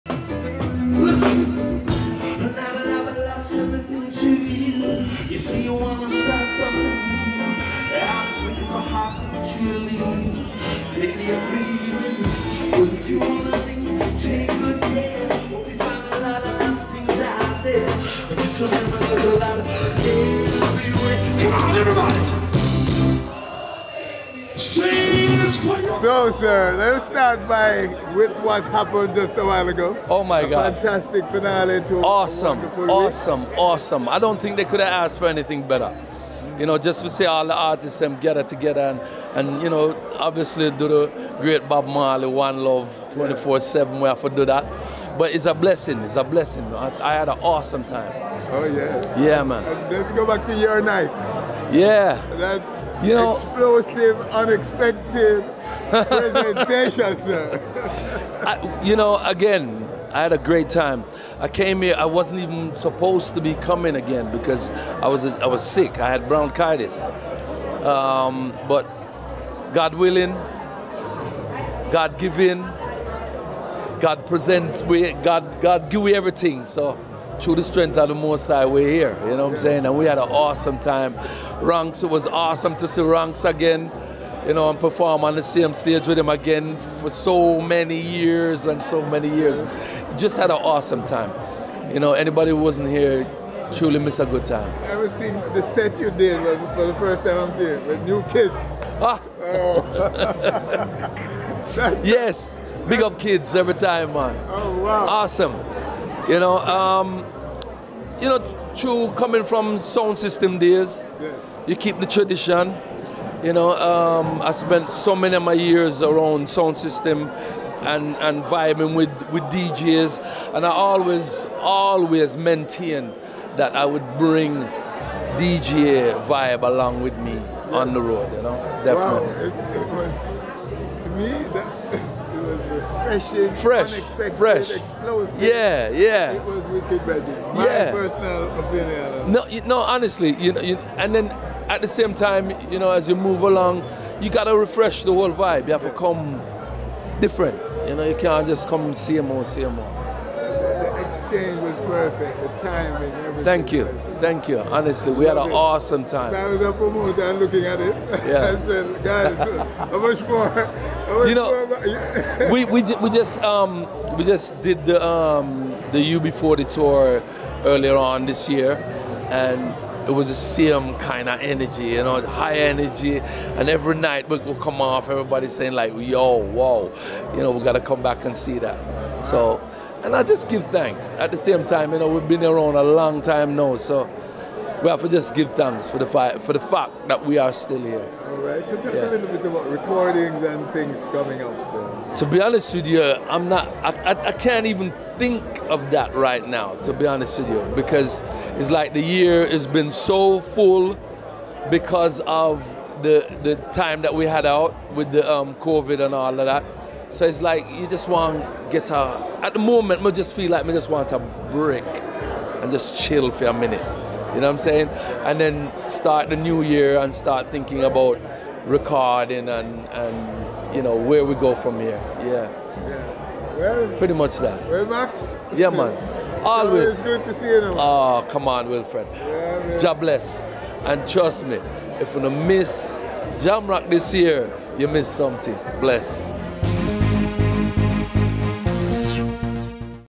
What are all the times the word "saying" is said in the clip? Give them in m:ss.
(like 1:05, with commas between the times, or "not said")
1:19, 2:55, 3:34.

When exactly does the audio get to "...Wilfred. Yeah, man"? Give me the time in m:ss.
3:48.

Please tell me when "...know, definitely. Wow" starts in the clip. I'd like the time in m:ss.
2:08.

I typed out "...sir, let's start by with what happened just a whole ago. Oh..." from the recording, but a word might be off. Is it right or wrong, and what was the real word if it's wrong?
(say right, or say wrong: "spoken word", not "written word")
wrong: "while", not "whole".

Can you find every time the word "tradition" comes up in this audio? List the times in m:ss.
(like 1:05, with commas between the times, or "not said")
1:52.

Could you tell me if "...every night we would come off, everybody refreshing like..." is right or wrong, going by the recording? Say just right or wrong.
wrong.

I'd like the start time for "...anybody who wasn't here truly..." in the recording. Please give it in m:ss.
1:32.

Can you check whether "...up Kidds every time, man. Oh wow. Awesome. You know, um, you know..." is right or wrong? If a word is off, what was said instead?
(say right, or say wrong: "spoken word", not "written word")
right.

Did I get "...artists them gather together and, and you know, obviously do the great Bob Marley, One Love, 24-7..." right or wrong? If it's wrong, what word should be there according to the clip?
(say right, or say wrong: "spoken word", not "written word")
right.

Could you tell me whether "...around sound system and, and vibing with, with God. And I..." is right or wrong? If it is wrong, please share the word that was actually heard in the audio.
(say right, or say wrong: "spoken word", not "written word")
wrong: "DJs", not "God".